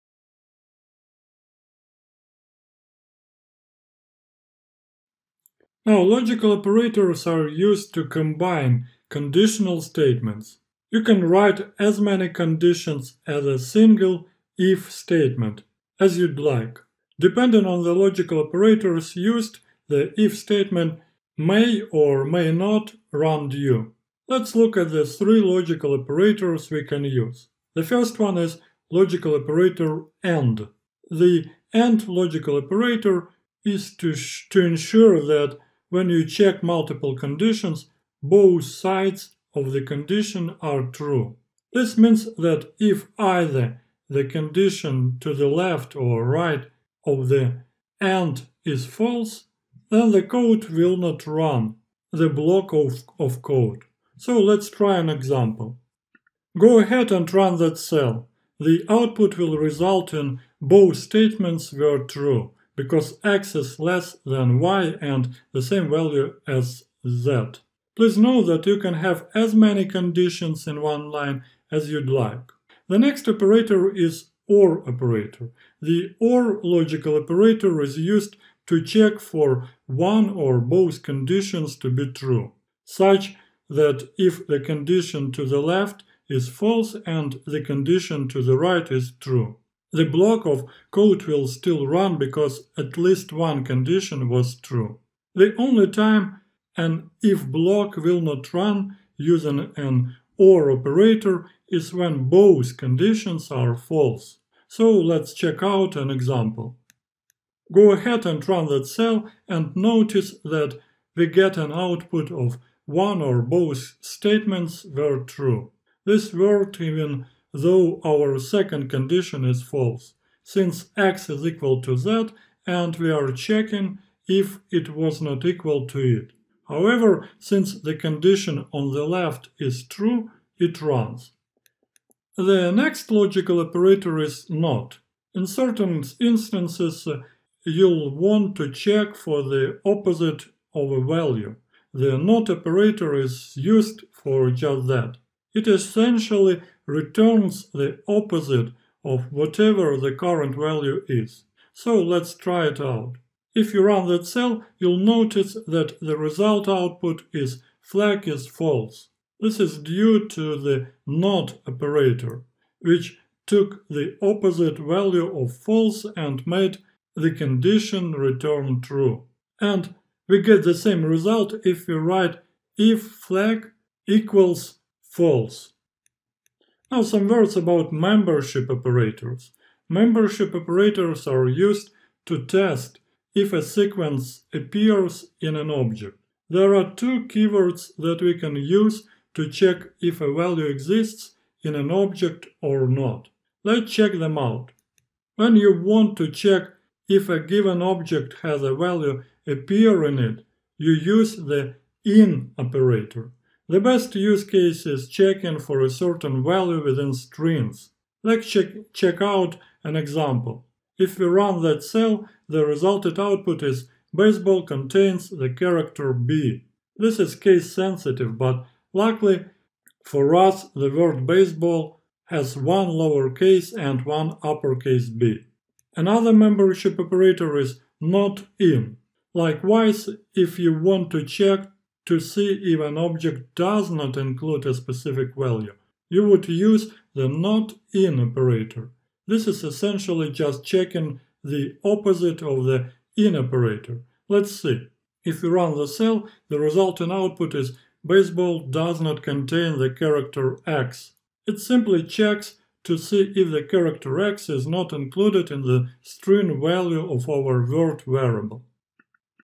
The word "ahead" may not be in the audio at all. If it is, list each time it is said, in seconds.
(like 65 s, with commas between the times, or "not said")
56 s, 107 s.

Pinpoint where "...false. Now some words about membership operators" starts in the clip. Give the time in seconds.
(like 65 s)
175 s.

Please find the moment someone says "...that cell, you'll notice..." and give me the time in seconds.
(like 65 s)
154 s.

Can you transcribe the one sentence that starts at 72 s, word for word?
The next operator is OR operator.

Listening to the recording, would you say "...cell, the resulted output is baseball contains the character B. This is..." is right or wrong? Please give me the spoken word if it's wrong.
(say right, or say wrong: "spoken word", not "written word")
right.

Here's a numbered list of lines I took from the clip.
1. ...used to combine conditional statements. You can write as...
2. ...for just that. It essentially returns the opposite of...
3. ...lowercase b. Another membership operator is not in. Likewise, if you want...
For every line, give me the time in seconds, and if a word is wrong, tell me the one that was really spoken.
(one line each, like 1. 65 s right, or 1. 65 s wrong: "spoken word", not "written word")
1. 7 s right
2. 144 s right
3. 224 s wrong: "uppercase", not "lowercase".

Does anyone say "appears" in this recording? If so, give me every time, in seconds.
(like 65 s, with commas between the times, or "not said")
184 s, 199 s.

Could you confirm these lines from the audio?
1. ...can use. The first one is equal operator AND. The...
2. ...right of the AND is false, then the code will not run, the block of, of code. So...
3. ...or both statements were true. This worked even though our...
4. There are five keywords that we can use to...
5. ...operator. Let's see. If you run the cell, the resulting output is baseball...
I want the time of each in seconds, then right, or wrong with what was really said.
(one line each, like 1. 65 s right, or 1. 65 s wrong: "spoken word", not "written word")
1. 26 s wrong: "logical", not "equal"
2. 46 s right
3. 113 s right
4. 186 s wrong: "two", not "five"
5. 243 s right.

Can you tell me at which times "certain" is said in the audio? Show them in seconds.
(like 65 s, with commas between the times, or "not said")
135 s, 205 s.